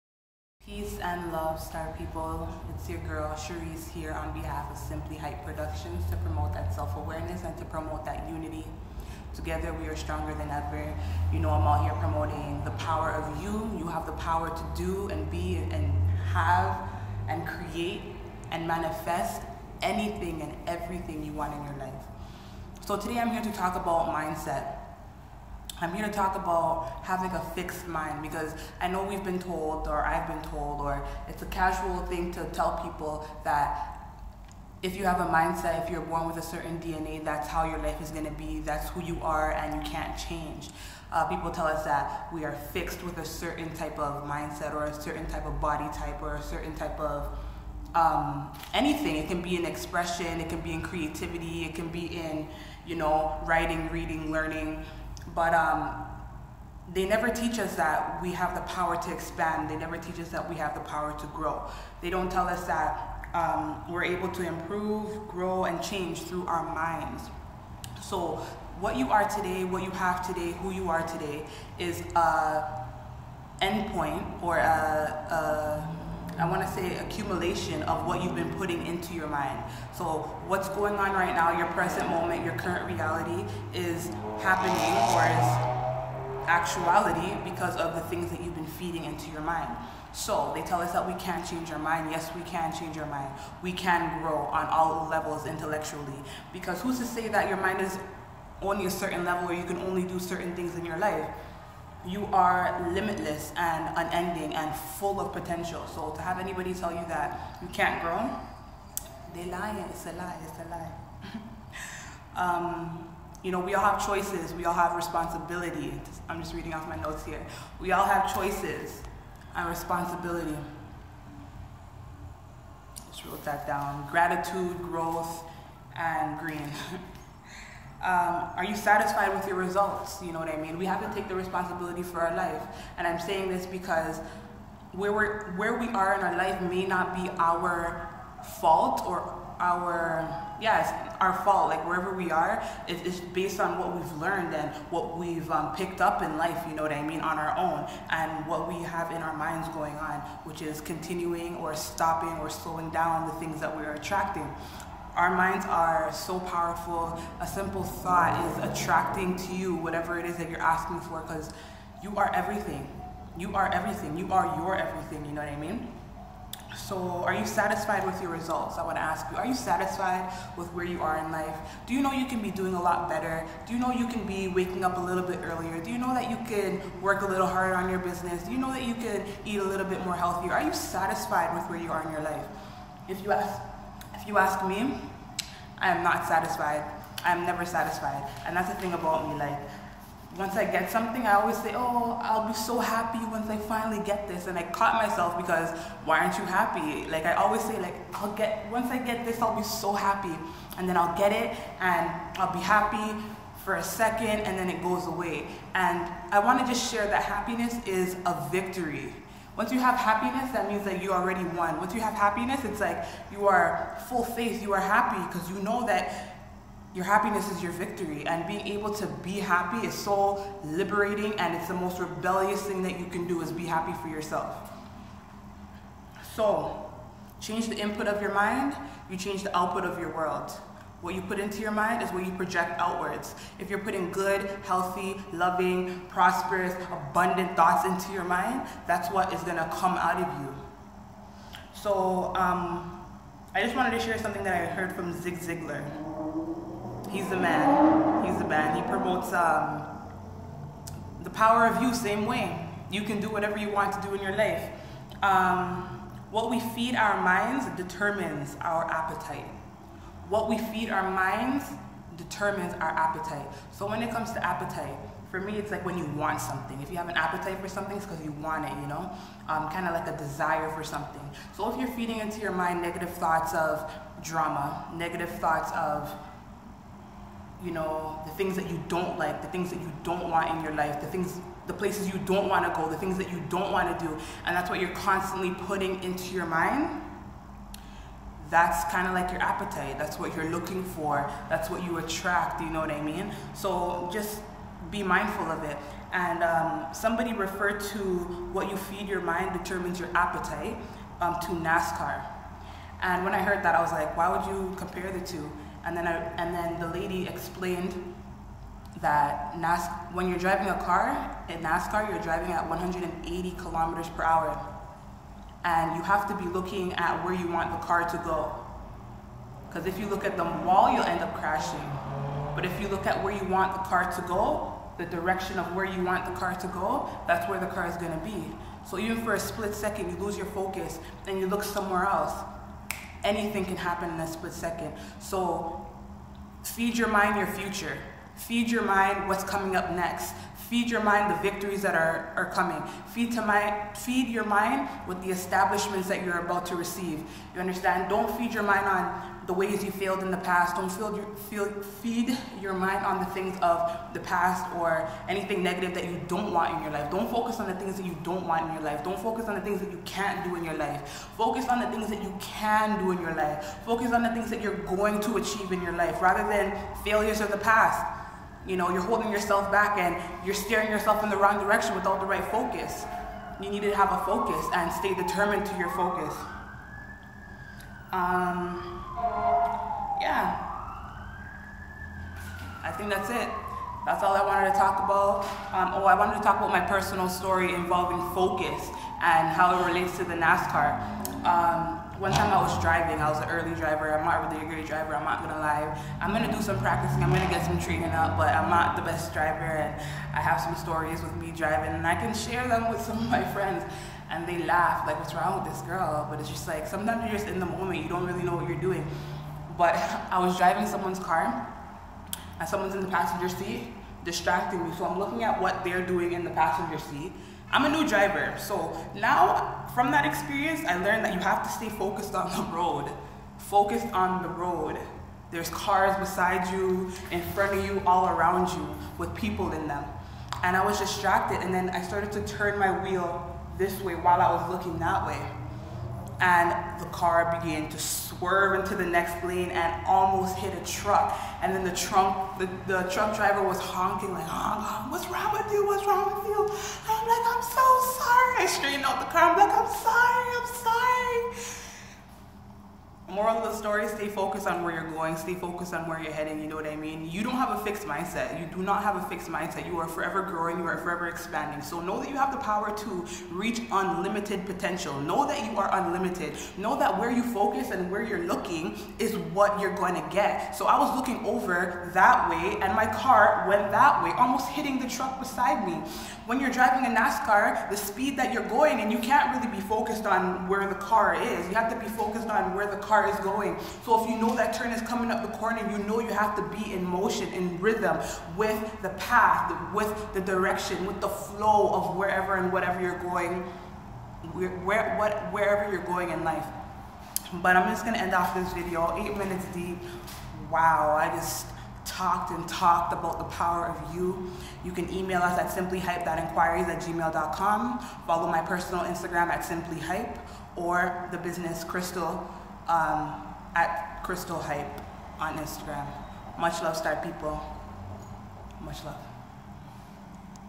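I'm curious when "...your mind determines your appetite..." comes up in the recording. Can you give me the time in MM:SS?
04:59.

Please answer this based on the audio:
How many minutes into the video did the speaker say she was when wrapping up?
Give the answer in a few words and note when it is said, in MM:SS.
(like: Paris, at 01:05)
8, at 08:19.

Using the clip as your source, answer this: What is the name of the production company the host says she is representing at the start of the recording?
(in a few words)
Simply Hype Productions.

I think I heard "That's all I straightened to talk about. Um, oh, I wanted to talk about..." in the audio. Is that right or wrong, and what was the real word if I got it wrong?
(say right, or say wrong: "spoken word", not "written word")
wrong: "wanted", not "straightened".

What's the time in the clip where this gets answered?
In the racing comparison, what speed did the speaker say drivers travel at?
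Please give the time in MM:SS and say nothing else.
05:12.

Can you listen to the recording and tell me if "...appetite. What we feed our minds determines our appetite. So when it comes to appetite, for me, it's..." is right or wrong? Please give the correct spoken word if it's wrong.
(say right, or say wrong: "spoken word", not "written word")
right.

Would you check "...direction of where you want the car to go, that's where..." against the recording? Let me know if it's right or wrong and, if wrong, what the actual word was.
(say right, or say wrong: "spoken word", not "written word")
right.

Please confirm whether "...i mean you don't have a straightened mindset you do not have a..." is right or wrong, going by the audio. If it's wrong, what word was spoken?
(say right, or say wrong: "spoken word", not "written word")
wrong: "fixed", not "straightened".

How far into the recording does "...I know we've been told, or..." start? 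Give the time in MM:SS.
00:28.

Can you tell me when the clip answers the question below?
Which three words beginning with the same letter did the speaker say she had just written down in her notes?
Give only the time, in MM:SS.
02:04.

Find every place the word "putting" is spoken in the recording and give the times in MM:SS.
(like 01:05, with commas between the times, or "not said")
01:18, 03:53, 04:45.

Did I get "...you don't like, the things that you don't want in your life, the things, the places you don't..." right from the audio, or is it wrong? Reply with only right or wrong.
right.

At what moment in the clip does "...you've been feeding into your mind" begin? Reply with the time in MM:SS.
01:28.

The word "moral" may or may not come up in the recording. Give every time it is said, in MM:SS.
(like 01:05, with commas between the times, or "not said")
07:33.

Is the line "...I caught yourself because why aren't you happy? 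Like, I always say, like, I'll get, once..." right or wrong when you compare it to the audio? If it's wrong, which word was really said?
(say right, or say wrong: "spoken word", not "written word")
wrong: "myself", not "yourself".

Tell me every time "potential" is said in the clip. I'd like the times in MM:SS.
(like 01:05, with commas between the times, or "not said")
01:45, 07:44.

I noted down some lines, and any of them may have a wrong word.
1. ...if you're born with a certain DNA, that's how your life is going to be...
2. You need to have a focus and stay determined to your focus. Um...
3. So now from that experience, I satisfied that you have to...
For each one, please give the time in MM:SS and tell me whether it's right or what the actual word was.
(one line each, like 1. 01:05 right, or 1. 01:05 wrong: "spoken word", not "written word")
1. 00:35 right
2. 06:13 right
3. 06:58 wrong: "learned", not "satisfied".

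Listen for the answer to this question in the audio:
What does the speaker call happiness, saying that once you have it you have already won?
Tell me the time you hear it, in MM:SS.
03:28.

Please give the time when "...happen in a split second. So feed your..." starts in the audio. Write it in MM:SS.
05:33.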